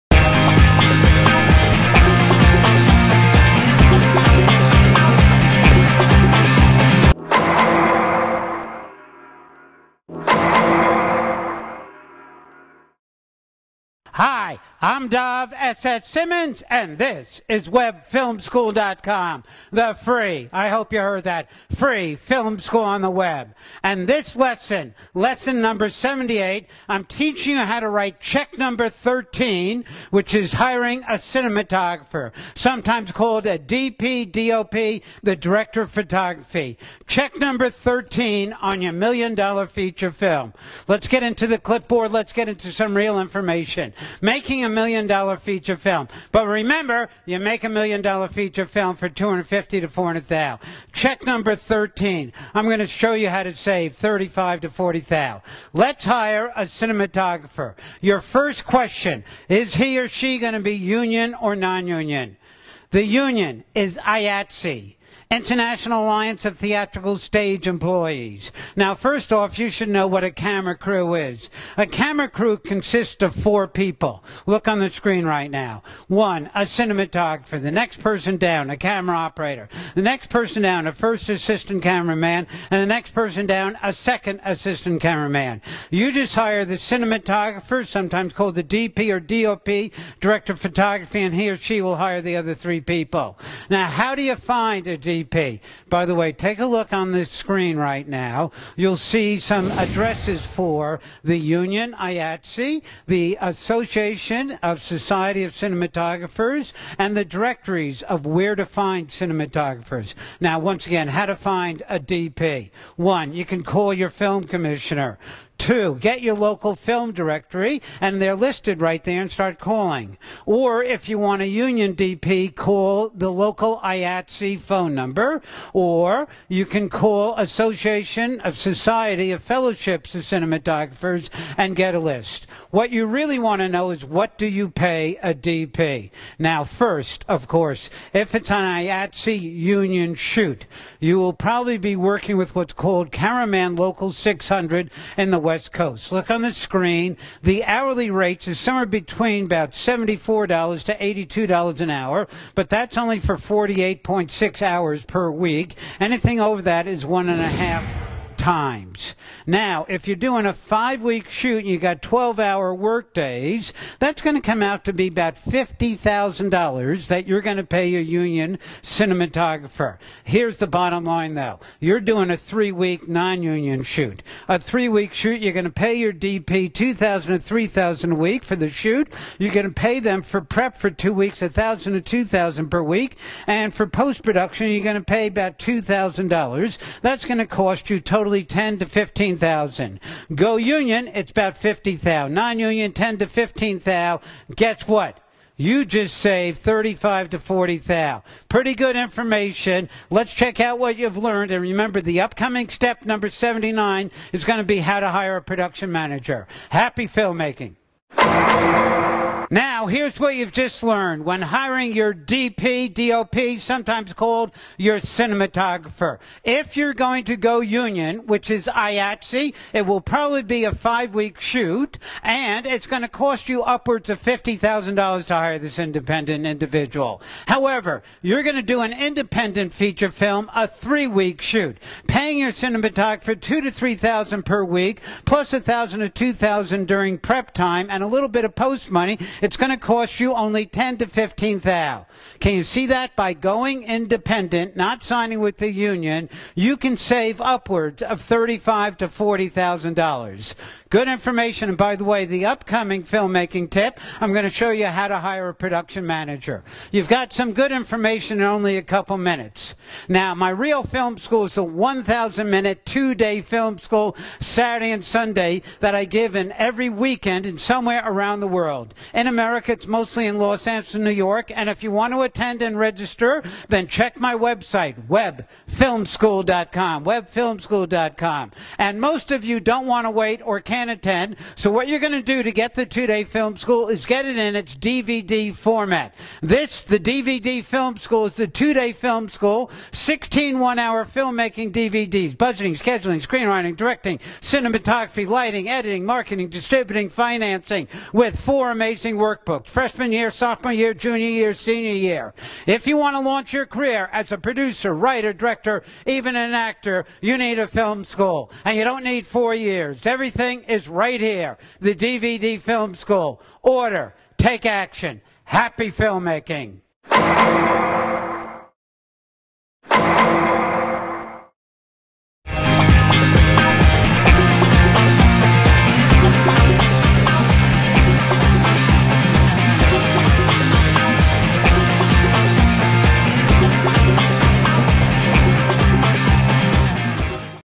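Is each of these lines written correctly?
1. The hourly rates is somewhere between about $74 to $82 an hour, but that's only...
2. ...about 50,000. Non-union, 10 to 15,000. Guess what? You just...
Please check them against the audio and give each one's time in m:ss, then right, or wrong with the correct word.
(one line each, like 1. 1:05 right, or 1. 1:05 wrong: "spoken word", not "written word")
1. 2:27 right
2. 3:11 right.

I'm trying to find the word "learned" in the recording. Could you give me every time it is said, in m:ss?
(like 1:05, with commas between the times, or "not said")
3:21, 3:30.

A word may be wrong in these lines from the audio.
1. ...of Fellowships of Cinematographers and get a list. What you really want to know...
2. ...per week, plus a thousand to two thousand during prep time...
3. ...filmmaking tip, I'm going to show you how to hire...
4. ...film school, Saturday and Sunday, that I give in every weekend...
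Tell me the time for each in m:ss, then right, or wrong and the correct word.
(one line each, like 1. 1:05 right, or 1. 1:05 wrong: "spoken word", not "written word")
1. 2:09 right
2. 3:54 right
3. 4:13 right
4. 4:23 right.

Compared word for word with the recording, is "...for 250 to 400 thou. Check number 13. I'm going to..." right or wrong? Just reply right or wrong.
right.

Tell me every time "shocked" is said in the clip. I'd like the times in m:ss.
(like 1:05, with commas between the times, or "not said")
not said.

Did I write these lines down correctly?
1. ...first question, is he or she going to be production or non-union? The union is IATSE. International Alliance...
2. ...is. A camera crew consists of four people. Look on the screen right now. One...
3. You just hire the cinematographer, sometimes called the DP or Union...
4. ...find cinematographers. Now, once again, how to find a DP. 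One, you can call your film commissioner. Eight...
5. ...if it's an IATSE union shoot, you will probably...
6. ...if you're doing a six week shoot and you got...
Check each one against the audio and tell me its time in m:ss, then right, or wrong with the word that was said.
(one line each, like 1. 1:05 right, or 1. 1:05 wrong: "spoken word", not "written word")
1. 0:58 wrong: "union", not "production"
2. 1:11 right
3. 1:25 wrong: "DOP", not "Union"
4. 1:48 wrong: "Two", not "Eight"
5. 2:18 right
6. 2:39 wrong: "five", not "six".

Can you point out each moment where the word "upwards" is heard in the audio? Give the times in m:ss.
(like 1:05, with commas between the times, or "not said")
3:43, 4:07.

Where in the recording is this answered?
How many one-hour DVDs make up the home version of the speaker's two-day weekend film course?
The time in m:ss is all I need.
4:49.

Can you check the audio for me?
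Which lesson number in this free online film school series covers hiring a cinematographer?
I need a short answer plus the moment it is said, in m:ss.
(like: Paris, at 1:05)
78, at 0:25.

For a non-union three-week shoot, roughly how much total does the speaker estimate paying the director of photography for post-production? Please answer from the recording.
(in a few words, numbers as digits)
$2,000.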